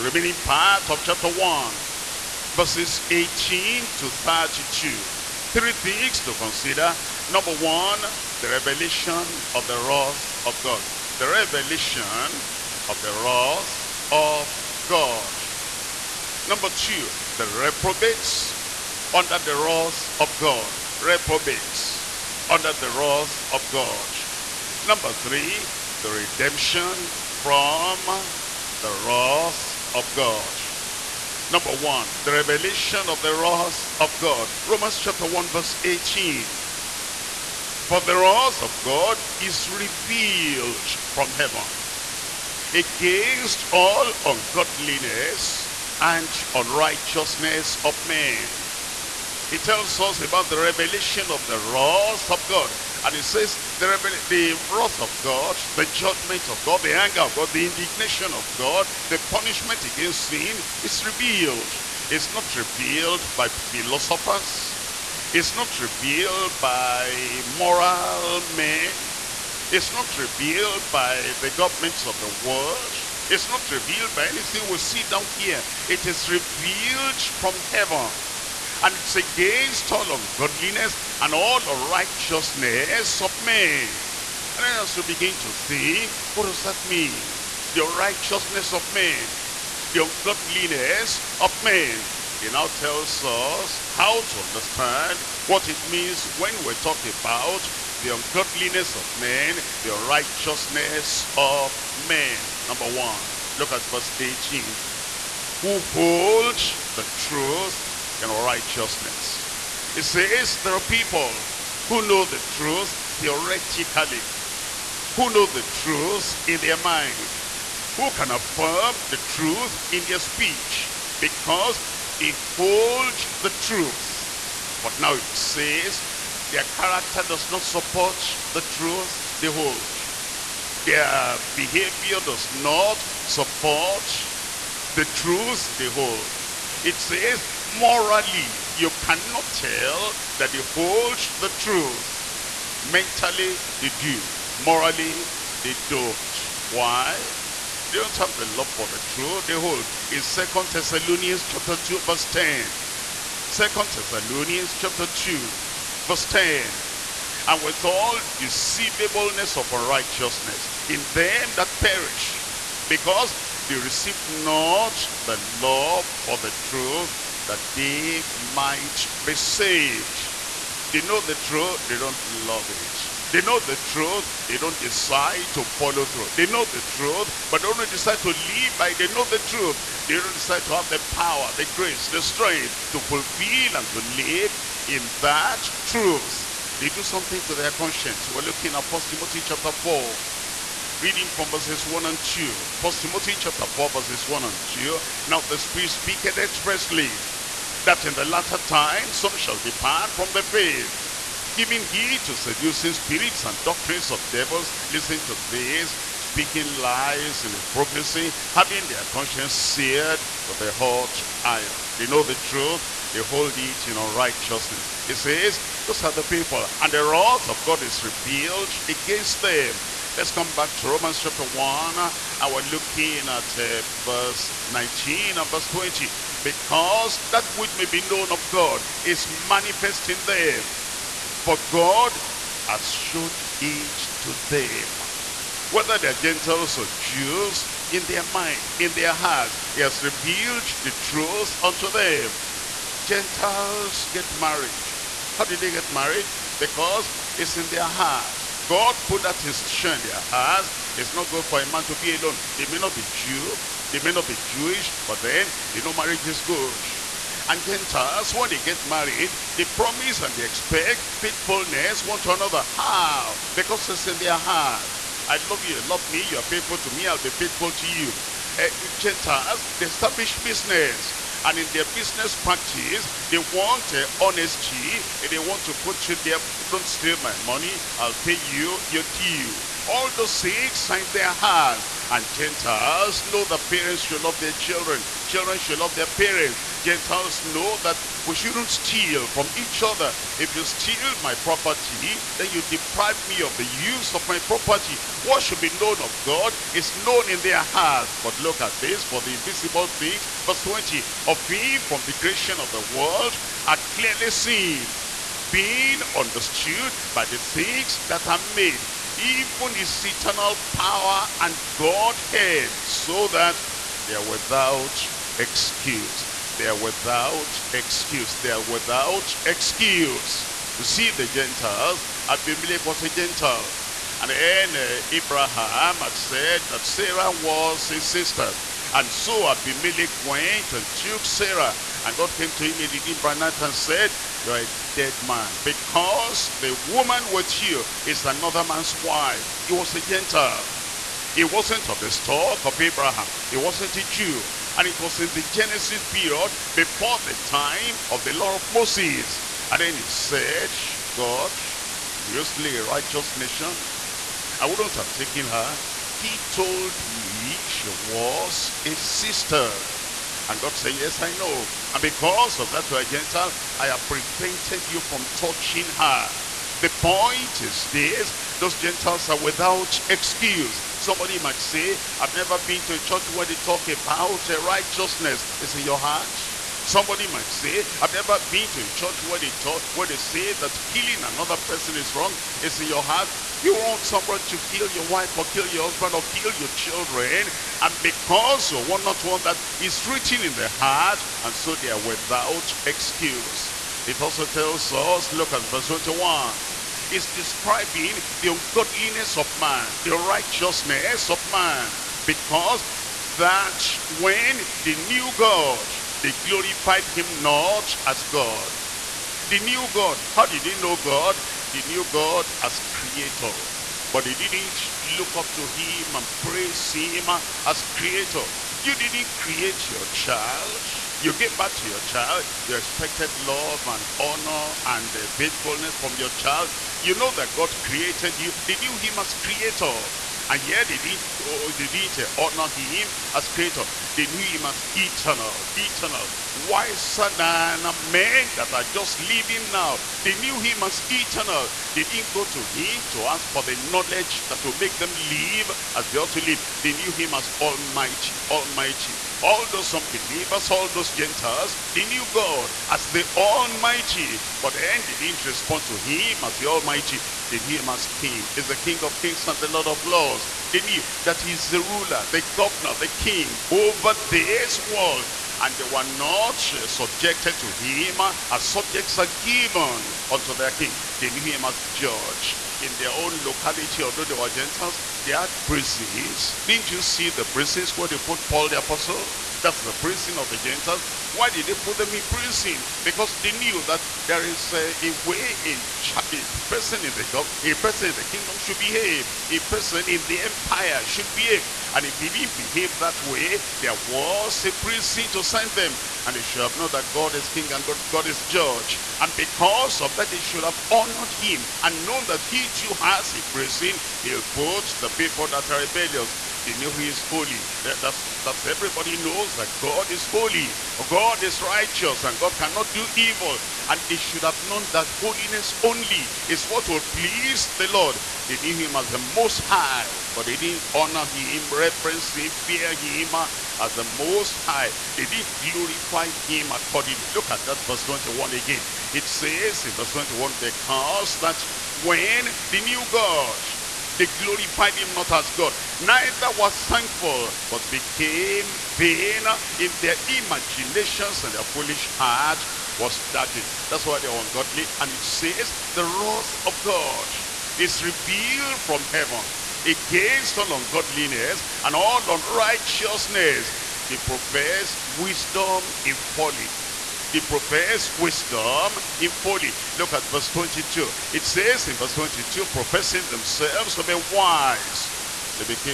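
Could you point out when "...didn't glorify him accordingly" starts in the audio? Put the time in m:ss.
8:45.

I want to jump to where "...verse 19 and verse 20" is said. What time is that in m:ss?
3:44.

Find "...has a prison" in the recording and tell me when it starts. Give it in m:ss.
8:23.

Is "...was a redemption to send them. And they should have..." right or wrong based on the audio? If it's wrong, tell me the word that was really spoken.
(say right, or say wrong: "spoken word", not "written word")
wrong: "prison", not "redemption".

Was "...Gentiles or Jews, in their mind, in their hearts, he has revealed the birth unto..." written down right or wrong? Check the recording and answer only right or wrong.
wrong.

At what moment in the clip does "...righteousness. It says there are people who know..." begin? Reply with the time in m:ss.
1:48.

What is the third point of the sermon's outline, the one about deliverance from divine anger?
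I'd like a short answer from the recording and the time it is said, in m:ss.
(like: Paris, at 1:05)
The redemption from the wrath of God, at 0:26.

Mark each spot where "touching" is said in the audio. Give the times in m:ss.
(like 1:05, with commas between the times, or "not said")
6:05.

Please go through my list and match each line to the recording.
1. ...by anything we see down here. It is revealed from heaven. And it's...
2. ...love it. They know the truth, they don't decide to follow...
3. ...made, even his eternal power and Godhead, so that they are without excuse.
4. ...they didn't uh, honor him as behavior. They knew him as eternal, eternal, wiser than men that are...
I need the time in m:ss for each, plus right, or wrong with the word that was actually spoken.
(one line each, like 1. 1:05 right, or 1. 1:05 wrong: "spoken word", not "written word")
1. 1:14 right
2. 2:52 right
3. 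5:08 right
4. 7:11 wrong: "creator", not "behavior".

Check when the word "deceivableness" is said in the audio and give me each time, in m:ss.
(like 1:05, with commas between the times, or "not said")
2:38.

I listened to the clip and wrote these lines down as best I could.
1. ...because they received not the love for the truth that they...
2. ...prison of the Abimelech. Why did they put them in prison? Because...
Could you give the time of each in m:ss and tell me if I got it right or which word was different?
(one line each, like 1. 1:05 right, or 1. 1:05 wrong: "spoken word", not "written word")
1. 2:42 right
2. 7:59 wrong: "Gentiles", not "Abimelech".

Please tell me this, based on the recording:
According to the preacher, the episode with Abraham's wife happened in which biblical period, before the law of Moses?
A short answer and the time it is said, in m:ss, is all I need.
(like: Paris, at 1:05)
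The Genesis period, at 5:45.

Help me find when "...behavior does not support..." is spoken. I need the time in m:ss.
2:11.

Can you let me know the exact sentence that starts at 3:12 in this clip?
1 Timothy chapter 4, verses 1 and 2.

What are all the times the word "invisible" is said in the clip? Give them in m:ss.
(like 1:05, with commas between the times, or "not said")
4:59.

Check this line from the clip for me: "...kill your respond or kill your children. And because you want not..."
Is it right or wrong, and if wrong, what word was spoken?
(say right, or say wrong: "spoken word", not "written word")
wrong: "husband", not "respond".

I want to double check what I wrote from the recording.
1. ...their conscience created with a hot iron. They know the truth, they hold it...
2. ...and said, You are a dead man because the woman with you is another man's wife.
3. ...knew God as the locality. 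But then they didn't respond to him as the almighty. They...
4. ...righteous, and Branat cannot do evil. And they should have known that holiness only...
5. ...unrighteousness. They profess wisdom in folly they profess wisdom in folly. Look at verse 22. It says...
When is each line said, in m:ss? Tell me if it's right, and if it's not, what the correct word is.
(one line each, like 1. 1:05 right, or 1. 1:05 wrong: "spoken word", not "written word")
1. 3:28 wrong: "seared", not "created"
2. 5:33 right
3. 7:32 wrong: "almighty", not "locality"
4. 8:31 wrong: "God", not "Branat"
5. 9:12 right.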